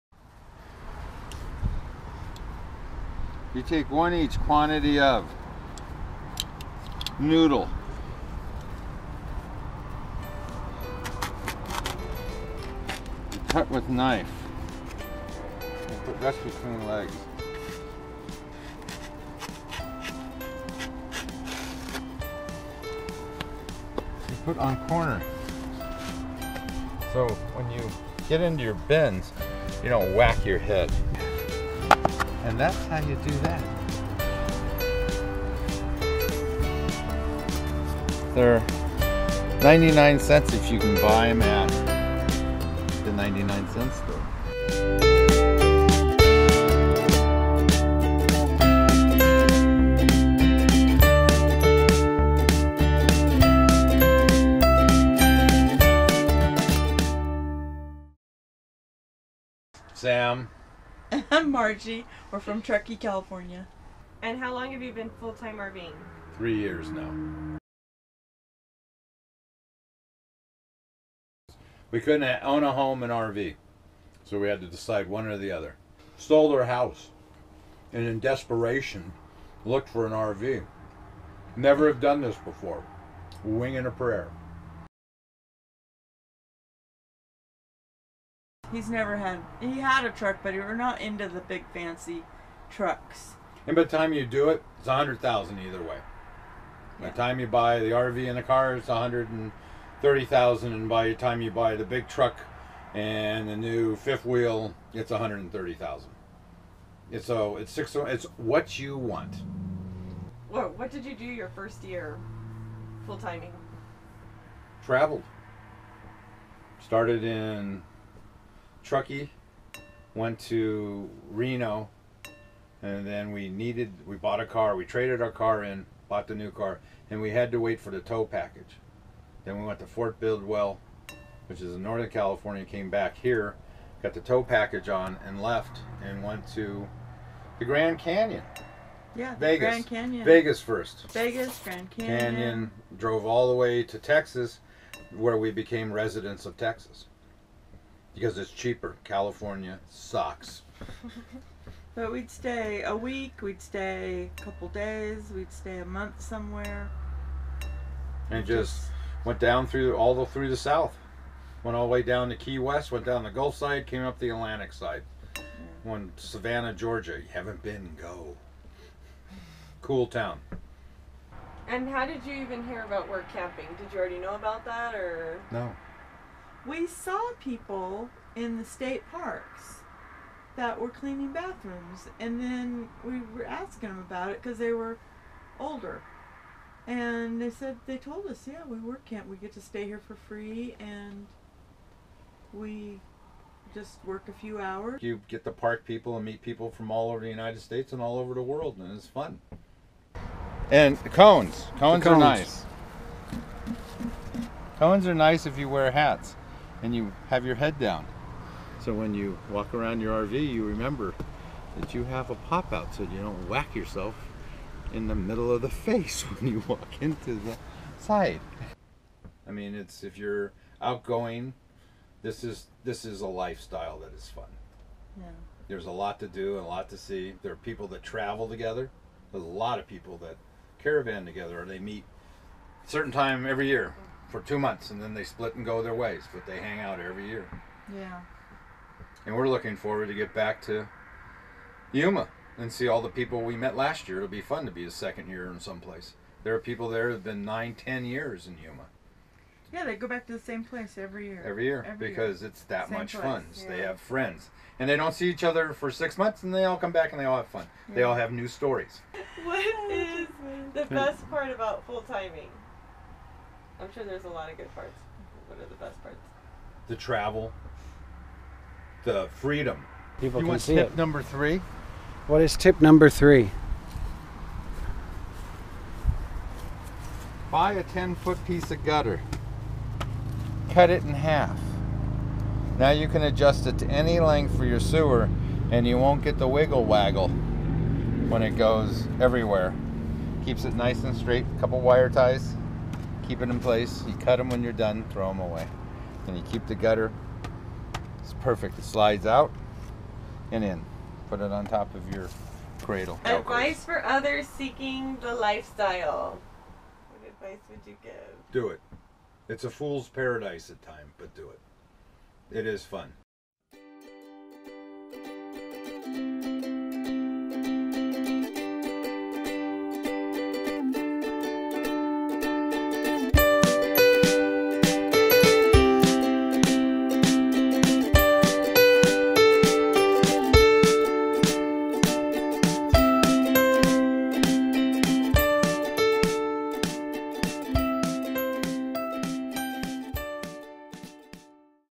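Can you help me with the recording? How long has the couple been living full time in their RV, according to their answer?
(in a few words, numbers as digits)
3 years.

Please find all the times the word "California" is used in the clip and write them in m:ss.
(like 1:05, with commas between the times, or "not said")
1:02, 2:12, 2:29.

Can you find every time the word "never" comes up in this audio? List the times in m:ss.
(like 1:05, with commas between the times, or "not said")
1:21, 1:28.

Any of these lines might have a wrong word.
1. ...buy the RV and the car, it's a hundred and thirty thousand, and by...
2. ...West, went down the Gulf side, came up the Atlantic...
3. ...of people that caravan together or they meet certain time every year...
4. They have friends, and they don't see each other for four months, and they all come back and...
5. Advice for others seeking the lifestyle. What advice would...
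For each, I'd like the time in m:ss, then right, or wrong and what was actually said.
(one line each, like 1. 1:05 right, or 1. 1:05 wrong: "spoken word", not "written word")
1. 1:37 right
2. 2:42 right
3. 3:49 right
4. 4:13 wrong: "six", not "four"
5. 5:03 right.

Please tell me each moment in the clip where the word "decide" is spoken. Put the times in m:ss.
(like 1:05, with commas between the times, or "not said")
1:14.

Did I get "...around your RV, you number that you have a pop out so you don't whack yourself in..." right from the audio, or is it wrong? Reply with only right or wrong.
wrong.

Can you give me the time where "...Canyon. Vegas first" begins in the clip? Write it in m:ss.
2:19.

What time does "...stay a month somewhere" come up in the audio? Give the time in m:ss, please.
2:35.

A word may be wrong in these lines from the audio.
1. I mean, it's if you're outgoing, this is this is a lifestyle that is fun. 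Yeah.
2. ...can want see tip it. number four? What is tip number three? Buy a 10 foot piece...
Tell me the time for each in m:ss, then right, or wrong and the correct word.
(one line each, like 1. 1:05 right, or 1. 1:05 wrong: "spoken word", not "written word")
1. 3:39 right
2. 4:30 wrong: "three", not "four".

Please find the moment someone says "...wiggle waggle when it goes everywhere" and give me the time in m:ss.
4:46.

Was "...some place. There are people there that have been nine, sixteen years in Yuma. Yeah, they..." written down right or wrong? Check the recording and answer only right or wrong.
wrong.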